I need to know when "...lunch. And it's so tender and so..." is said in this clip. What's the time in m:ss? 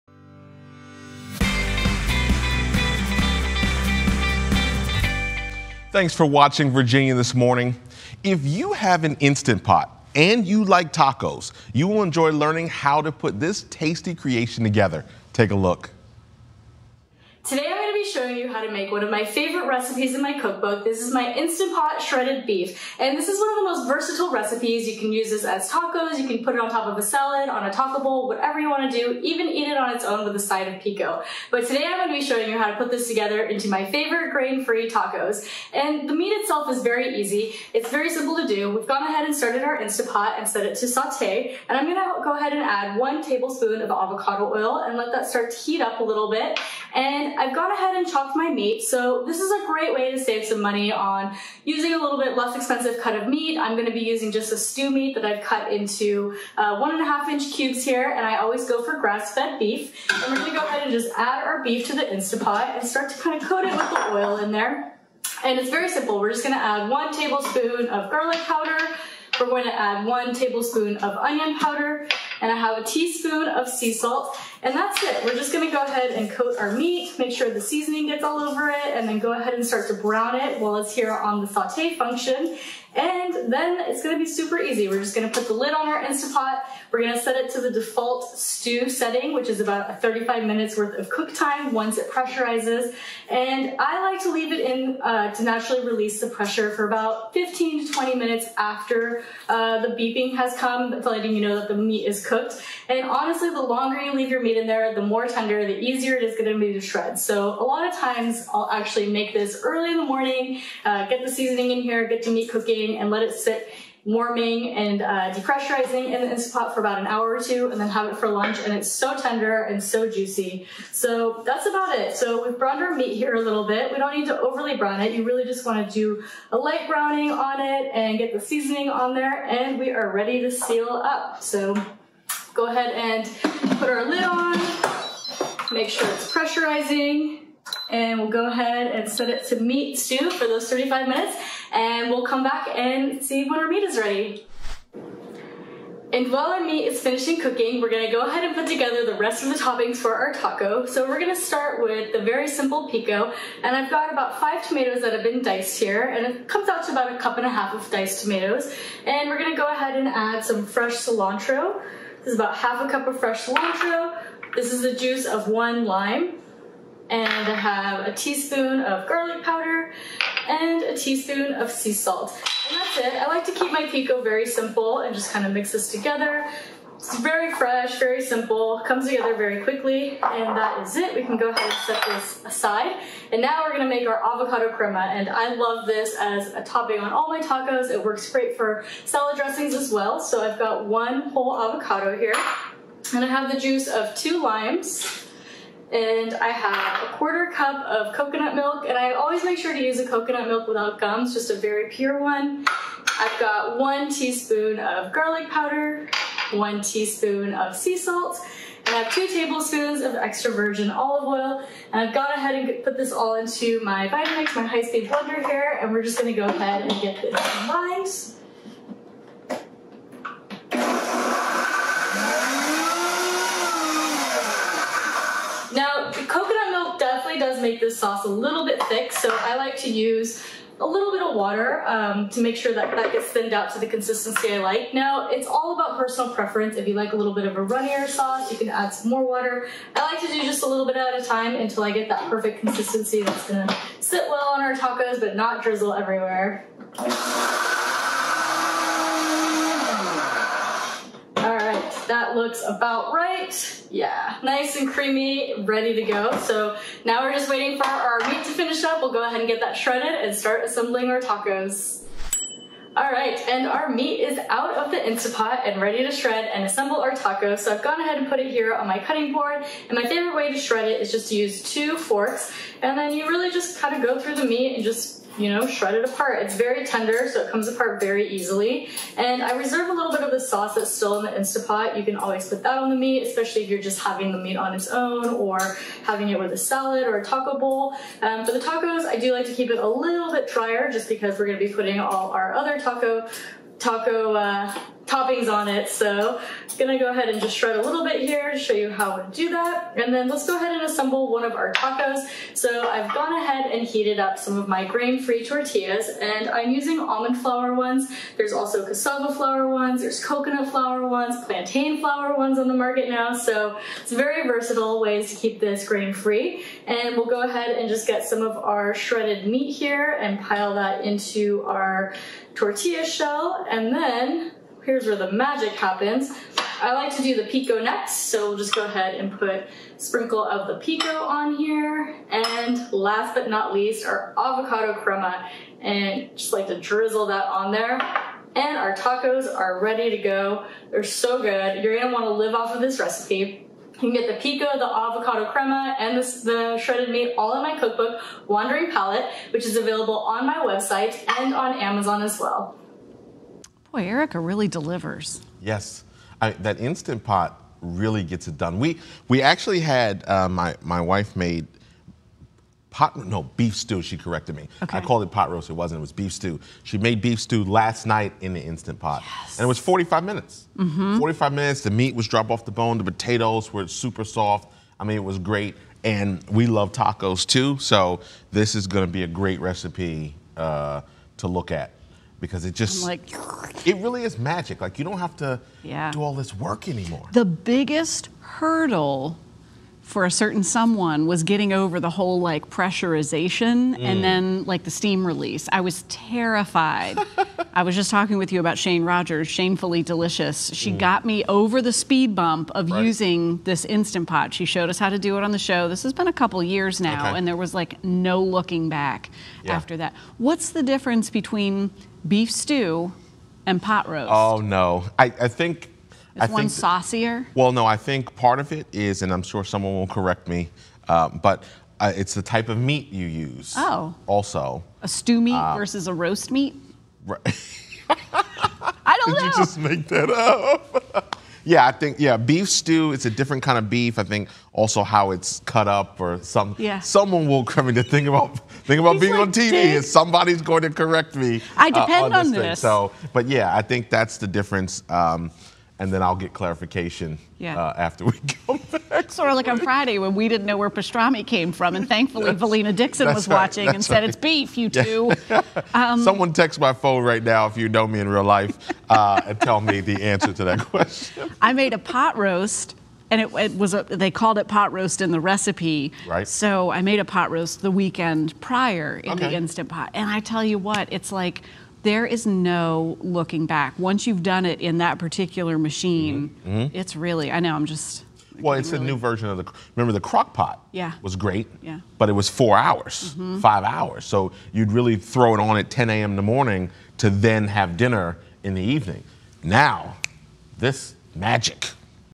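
1:58.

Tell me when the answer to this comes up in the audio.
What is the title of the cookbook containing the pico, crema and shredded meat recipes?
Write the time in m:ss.
5:48.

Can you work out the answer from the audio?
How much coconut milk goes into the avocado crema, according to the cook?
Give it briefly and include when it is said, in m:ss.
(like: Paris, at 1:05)
a quarter cup, at 3:17.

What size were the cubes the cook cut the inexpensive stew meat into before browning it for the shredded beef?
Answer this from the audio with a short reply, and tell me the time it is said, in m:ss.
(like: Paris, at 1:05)
1.5 inch, at 0:56.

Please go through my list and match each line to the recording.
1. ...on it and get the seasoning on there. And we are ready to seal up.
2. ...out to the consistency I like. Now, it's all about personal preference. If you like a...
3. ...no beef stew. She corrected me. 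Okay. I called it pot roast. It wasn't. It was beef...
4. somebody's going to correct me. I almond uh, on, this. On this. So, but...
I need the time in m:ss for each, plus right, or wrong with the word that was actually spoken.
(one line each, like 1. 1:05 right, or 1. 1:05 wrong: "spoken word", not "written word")
1. 2:07 right
2. 3:53 right
3. 6:03 right
4. 7:20 wrong: "depend", not "almond".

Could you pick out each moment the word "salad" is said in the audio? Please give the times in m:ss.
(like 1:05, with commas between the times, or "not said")
0:27, 3:09, 4:46.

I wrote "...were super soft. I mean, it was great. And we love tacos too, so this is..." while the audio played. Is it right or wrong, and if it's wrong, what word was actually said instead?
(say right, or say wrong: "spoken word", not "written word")
right.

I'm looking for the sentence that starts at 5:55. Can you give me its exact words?
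Yes, I, that Instant Pot really gets it done.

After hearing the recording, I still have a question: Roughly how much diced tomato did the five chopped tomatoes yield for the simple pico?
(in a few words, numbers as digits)
1.5 cups.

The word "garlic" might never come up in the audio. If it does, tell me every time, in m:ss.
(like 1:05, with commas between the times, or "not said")
1:08, 2:49, 3:25.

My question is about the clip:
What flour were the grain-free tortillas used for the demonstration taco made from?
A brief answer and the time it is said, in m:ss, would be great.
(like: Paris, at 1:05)
almond flour, at 5:07.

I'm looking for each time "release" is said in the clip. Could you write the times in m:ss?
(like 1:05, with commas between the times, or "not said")
1:35, 6:35.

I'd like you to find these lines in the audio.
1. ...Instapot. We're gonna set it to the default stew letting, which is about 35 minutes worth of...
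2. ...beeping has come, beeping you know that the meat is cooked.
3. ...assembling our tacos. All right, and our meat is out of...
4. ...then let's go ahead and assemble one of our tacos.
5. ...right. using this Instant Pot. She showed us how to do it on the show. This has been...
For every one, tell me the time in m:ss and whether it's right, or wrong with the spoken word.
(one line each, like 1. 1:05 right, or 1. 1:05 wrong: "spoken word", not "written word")
1. 1:26 wrong: "setting", not "letting"
2. 1:39 wrong: "letting", not "beeping"
3. 4:20 right
4. 5:00 right
5. 6:42 right.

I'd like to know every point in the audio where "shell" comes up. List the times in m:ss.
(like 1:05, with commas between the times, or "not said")
5:23.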